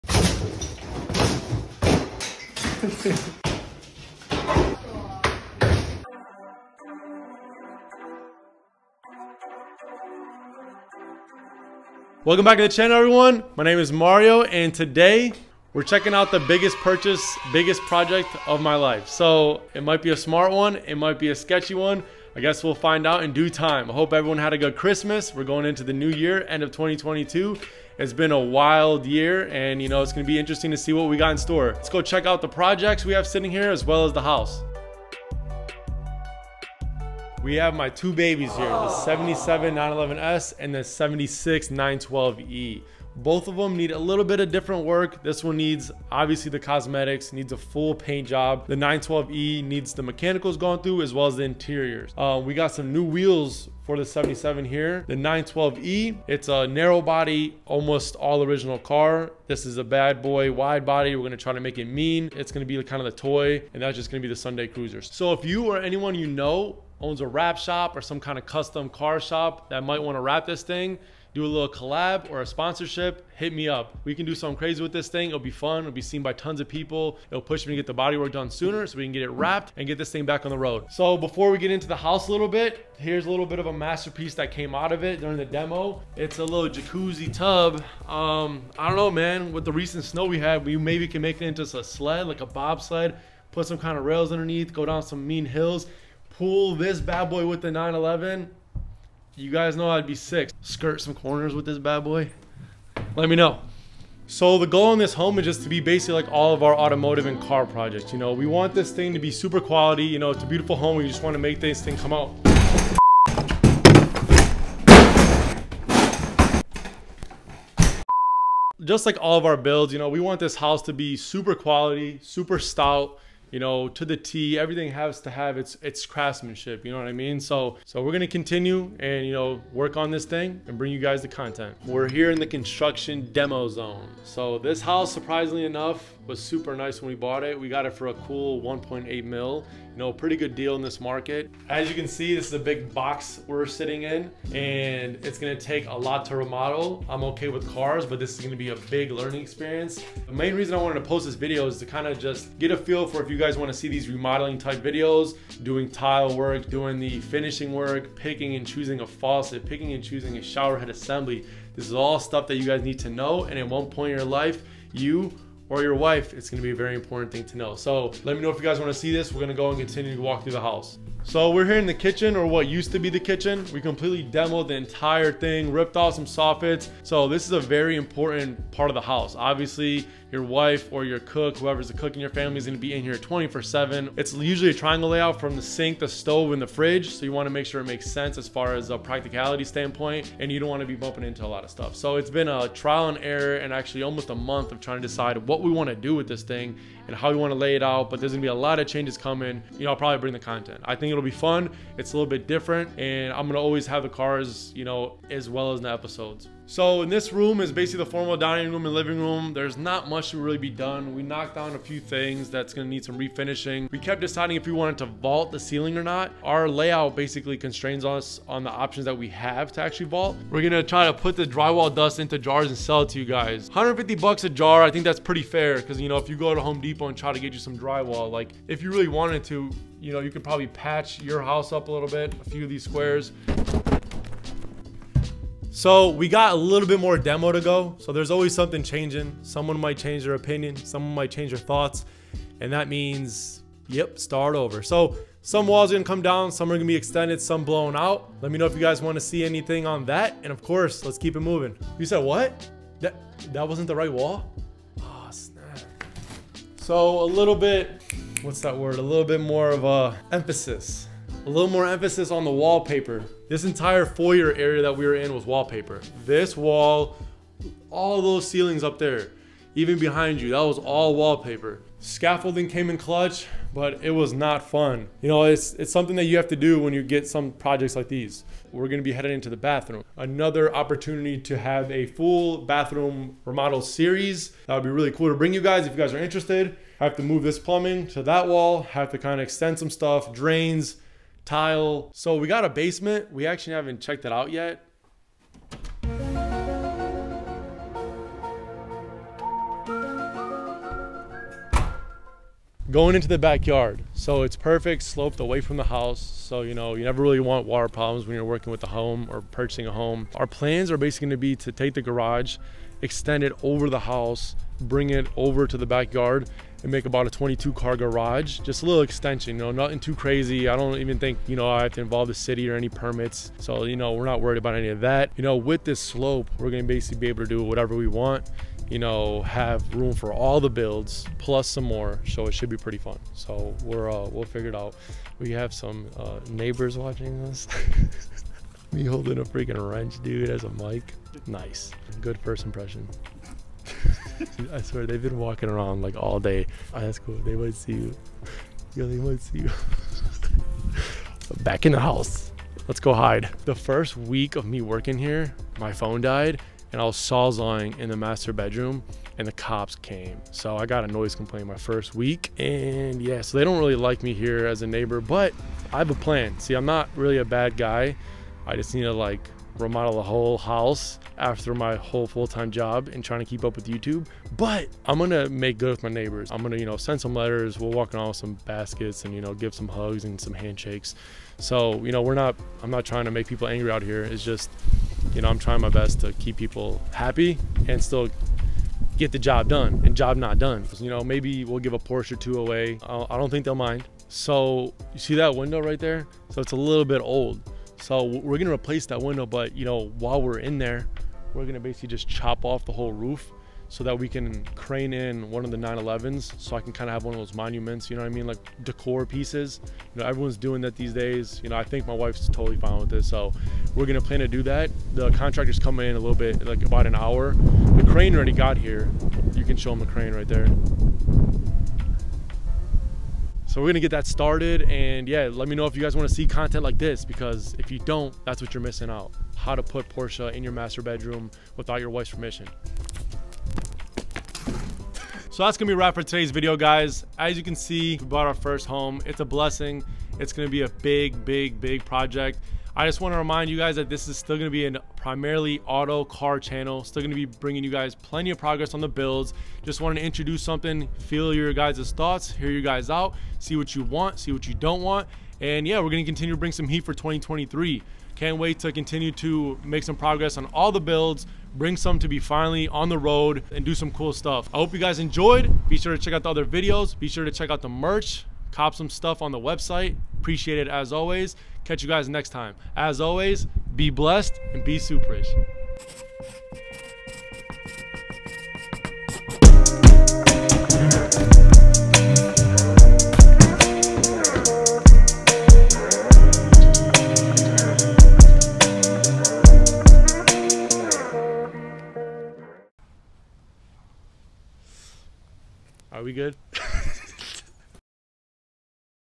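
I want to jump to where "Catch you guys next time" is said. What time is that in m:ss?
7:51.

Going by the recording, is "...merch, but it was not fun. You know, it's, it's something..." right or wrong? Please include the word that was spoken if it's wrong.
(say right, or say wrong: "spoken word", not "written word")
wrong: "clutch", not "merch".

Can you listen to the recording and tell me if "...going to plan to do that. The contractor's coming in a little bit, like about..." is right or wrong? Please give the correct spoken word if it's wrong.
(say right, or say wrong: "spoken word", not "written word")
right.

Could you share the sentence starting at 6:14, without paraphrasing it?
But I'm gonna make good with my neighbors.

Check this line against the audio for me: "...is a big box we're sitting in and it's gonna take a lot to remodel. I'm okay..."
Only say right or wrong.
right.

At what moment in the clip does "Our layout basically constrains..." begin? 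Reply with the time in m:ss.
3:36.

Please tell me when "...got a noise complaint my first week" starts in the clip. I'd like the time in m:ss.
6:00.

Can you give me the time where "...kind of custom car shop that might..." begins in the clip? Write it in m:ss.
1:08.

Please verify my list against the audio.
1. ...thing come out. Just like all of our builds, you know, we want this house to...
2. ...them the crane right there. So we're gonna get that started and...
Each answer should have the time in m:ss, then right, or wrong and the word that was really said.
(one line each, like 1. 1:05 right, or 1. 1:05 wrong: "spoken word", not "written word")
1. 1:51 right
2. 6:59 right.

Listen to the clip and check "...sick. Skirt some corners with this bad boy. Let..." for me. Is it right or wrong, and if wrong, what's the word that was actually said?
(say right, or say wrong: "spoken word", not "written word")
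right.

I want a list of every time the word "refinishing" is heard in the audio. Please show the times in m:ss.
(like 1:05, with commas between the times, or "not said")
3:33.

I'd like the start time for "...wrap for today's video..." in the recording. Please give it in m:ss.
7:15.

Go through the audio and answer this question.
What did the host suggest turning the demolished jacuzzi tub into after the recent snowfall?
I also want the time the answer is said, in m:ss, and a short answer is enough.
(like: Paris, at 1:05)
a bobsled, at 1:32.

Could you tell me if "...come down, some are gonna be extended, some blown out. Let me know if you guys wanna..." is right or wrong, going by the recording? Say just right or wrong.
right.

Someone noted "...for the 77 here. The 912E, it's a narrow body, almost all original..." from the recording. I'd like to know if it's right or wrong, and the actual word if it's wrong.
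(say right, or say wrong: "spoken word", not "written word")
right.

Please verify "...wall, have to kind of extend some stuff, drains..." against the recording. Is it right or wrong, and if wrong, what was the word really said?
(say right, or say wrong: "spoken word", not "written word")
right.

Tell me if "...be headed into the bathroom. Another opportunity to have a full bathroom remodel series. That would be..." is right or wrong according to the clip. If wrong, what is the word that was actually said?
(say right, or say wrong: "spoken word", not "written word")
right.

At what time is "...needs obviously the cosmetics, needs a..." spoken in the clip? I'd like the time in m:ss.
0:45.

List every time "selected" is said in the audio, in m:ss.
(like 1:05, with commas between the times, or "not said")
not said.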